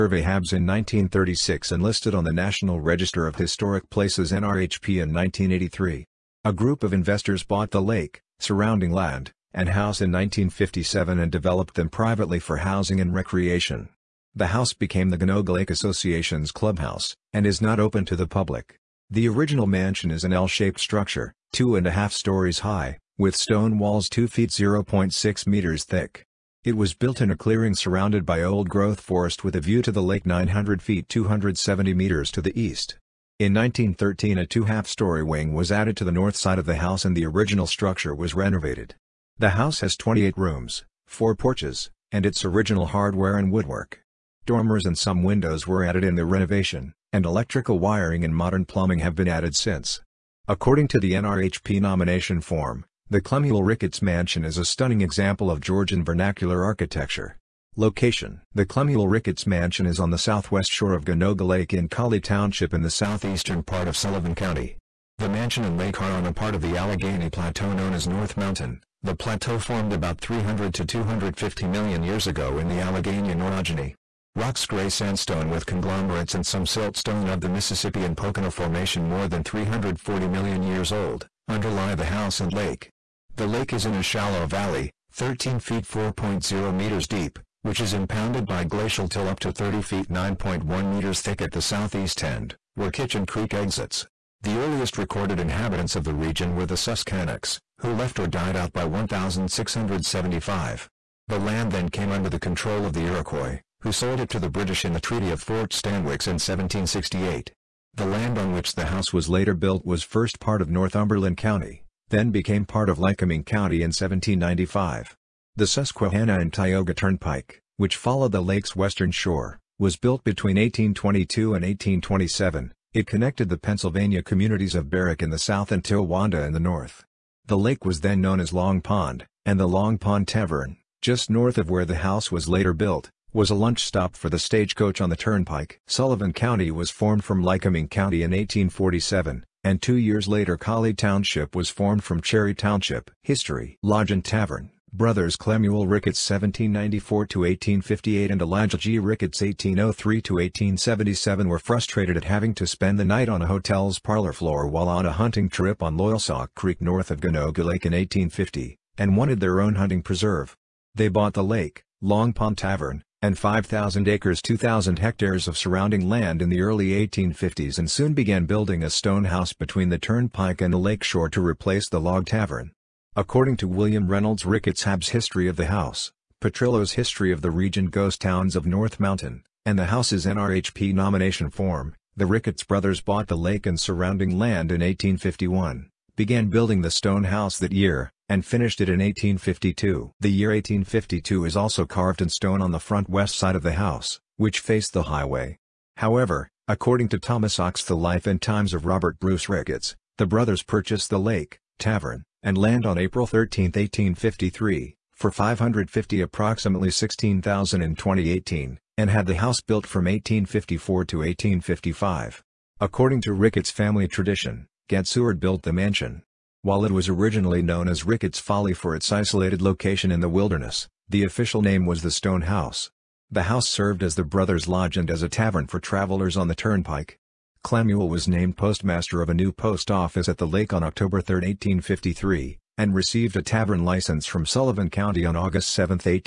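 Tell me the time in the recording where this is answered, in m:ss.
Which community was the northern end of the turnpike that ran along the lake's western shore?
2:05.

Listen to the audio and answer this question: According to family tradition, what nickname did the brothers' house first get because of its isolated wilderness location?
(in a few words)
Ricketts Folly.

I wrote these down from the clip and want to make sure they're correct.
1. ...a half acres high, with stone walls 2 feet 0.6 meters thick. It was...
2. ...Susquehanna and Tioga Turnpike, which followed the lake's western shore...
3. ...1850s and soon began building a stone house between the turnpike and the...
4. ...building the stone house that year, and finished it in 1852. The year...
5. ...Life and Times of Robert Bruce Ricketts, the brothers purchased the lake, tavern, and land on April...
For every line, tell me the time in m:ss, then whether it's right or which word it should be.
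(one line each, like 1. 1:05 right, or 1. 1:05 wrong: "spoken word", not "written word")
1. 0:21 wrong: "stories", not "acres"
2. 1:55 right
3. 2:46 right
4. 3:06 right
5. 3:17 right.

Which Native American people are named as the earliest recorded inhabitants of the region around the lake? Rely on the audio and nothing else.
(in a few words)
Susquehannocks.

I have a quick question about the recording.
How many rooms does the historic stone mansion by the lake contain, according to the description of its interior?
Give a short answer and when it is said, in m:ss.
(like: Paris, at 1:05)
28, at 0:39.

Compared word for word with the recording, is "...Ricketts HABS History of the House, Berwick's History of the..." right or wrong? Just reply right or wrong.
wrong.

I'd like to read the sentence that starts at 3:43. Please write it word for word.
The house served as the brothers' lodge and as a tavern for travelers on the turnpike.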